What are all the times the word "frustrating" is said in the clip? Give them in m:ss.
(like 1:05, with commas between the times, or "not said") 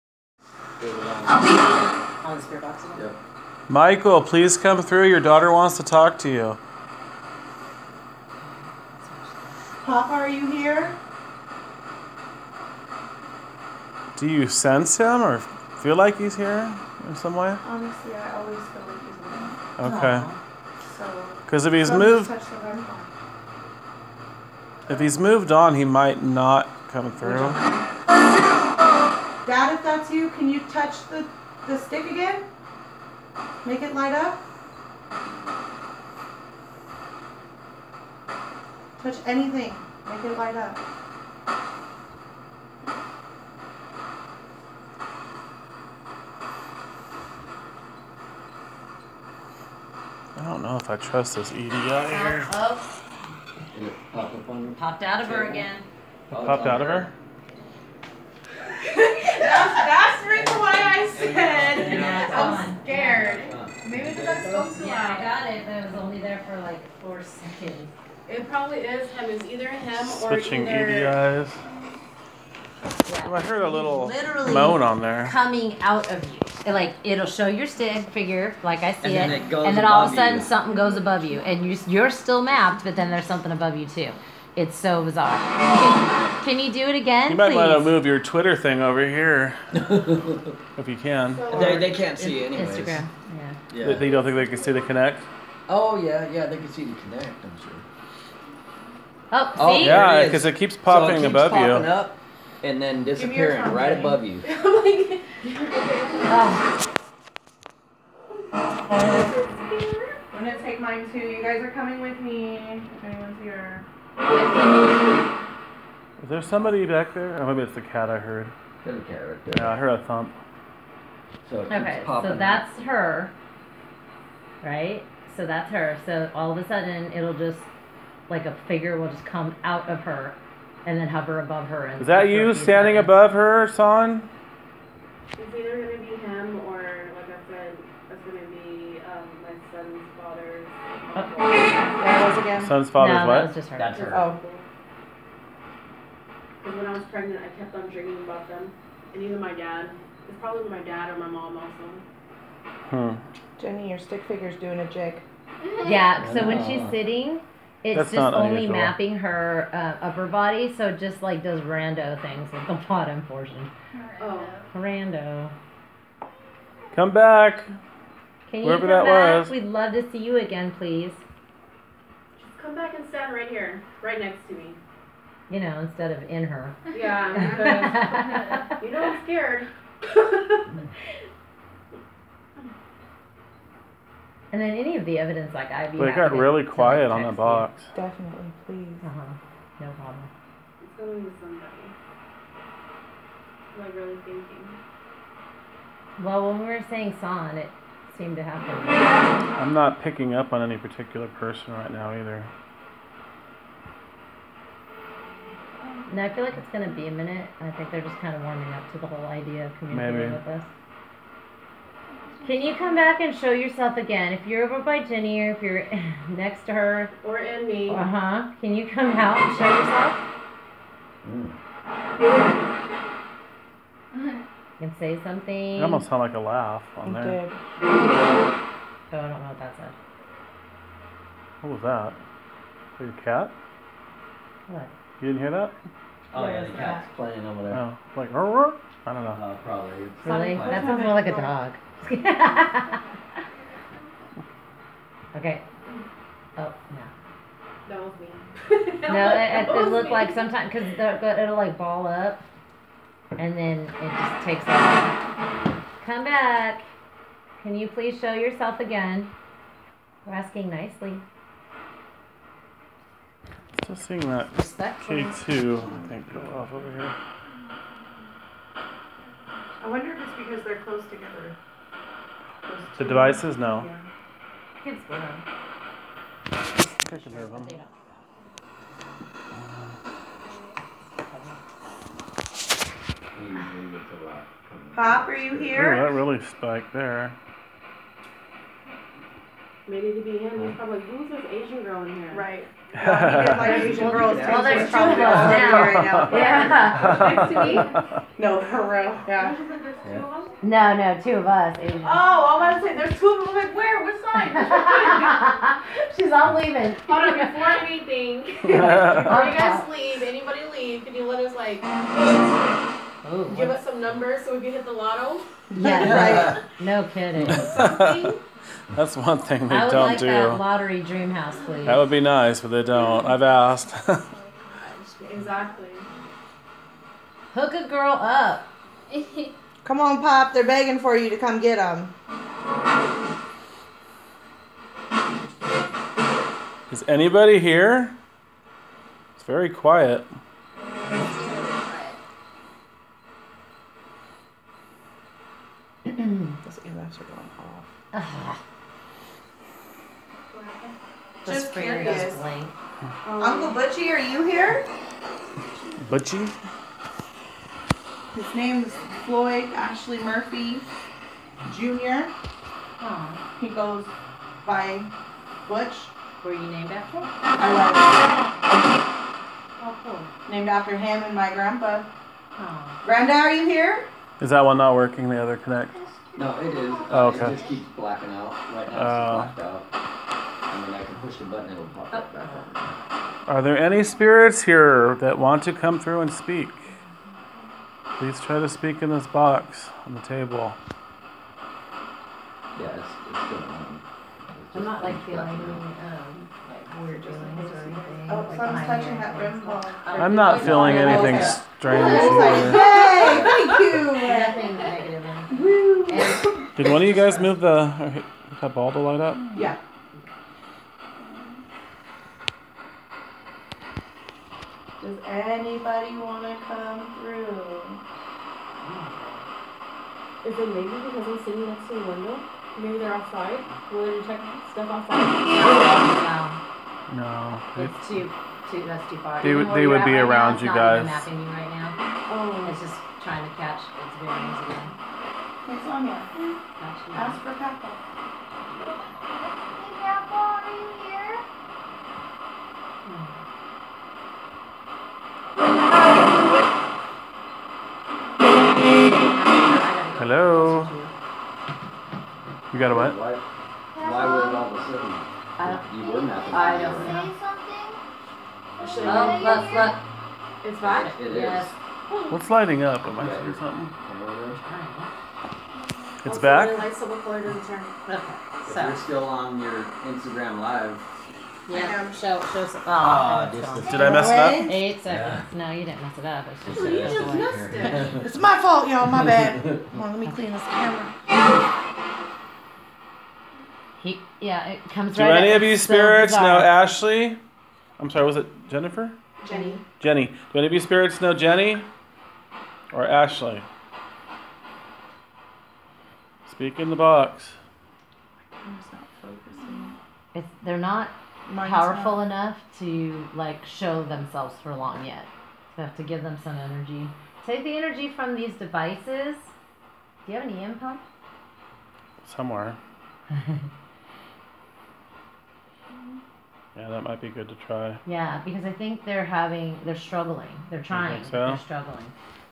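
not said.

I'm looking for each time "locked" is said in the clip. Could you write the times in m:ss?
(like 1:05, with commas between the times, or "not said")
not said.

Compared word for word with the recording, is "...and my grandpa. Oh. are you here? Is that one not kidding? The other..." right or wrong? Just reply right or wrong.
wrong.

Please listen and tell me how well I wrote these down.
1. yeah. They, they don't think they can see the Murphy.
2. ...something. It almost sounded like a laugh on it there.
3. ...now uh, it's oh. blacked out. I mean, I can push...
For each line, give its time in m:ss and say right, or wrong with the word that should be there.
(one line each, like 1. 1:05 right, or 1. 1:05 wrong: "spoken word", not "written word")
1. 1:33 wrong: "Kinect", not "Murphy"
2. 3:45 right
3. 6:18 right.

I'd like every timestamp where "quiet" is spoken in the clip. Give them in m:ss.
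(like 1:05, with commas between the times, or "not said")
3:06, 5:39.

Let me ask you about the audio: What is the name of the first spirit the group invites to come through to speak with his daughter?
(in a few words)
Michael.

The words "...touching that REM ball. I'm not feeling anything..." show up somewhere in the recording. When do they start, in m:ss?
6:38.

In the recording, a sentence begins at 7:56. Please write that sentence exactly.
It's just, well, you just away.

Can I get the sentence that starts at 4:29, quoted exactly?
I wonder if it's because they're close together.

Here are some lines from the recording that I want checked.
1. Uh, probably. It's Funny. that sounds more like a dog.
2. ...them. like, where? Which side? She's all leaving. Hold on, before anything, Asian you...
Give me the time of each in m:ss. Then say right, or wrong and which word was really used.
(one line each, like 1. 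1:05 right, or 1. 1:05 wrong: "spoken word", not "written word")
1. 3:59 right
2. 5:03 wrong: "Are", not "Asian".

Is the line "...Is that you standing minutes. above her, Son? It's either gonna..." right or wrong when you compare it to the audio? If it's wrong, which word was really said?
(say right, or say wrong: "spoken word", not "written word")
right.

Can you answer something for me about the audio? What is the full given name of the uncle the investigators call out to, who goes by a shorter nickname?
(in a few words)
Floyd Ashley Murphy Jr.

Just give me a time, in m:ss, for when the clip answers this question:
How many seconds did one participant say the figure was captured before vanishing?
1:07.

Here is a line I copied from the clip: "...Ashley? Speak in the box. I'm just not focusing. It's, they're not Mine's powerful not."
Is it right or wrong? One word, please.
right.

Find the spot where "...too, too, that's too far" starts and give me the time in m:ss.
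7:08.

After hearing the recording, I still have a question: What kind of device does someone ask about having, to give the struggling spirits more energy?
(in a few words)
EM pump.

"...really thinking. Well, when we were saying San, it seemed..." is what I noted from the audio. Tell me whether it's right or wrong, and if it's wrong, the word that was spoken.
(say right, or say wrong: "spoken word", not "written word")
right.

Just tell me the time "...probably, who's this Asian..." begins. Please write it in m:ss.
4:50.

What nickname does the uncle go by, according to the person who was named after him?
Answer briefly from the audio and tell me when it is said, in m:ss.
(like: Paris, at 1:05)
Butch, at 6:05.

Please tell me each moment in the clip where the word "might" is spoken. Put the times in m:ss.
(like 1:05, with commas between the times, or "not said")
0:25, 1:27, 8:37.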